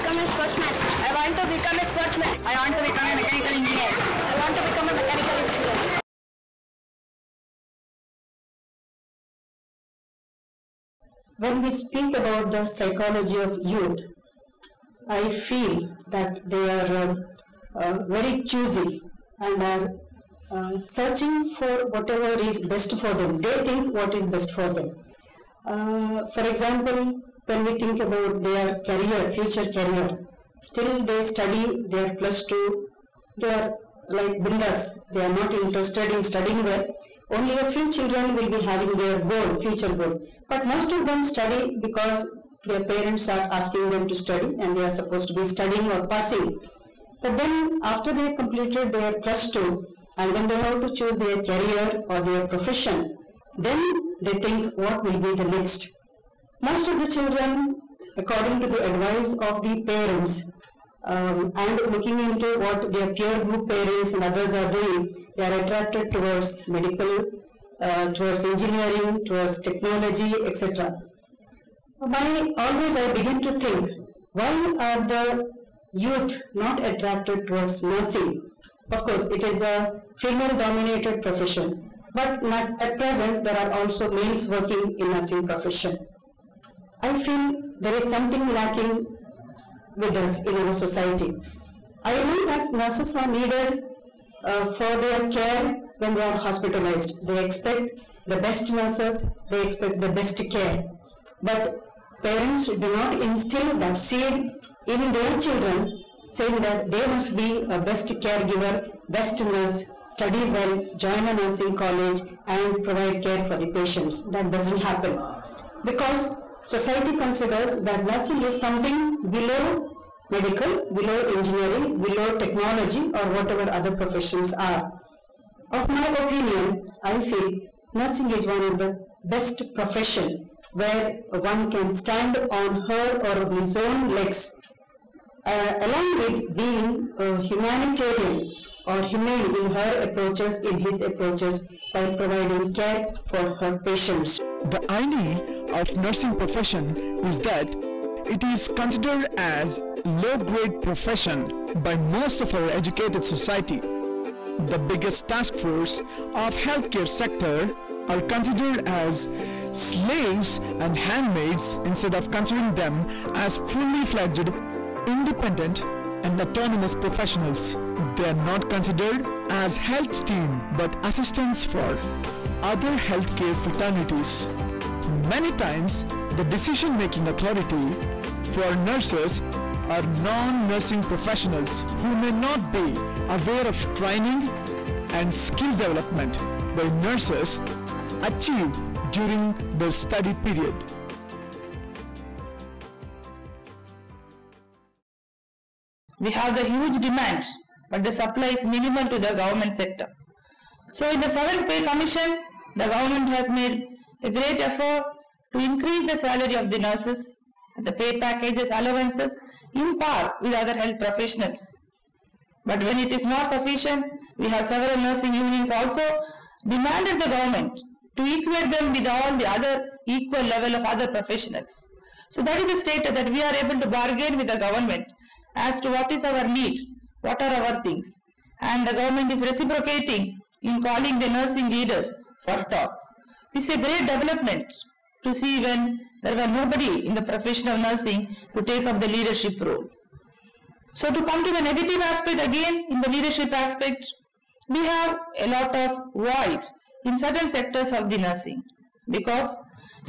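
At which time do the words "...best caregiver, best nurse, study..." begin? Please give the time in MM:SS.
01:47.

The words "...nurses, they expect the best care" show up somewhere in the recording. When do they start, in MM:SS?
01:38.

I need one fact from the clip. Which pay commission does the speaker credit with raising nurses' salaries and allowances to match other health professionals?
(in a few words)
7th Pay Commission.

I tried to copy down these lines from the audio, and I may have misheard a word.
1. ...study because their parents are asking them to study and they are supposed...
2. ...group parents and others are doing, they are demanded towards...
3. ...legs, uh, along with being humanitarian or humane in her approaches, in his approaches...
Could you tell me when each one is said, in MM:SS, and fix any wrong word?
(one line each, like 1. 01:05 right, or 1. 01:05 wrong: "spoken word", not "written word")
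1. 00:41 right
2. 01:03 wrong: "attracted", not "demanded"
3. 02:14 right.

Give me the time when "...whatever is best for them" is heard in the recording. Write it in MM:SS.
00:21.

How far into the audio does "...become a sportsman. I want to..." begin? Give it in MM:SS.
00:01.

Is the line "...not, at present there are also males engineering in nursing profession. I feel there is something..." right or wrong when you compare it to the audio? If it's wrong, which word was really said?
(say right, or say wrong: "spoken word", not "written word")
wrong: "working", not "engineering".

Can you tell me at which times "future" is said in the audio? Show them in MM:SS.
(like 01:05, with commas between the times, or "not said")
00:29, 00:39.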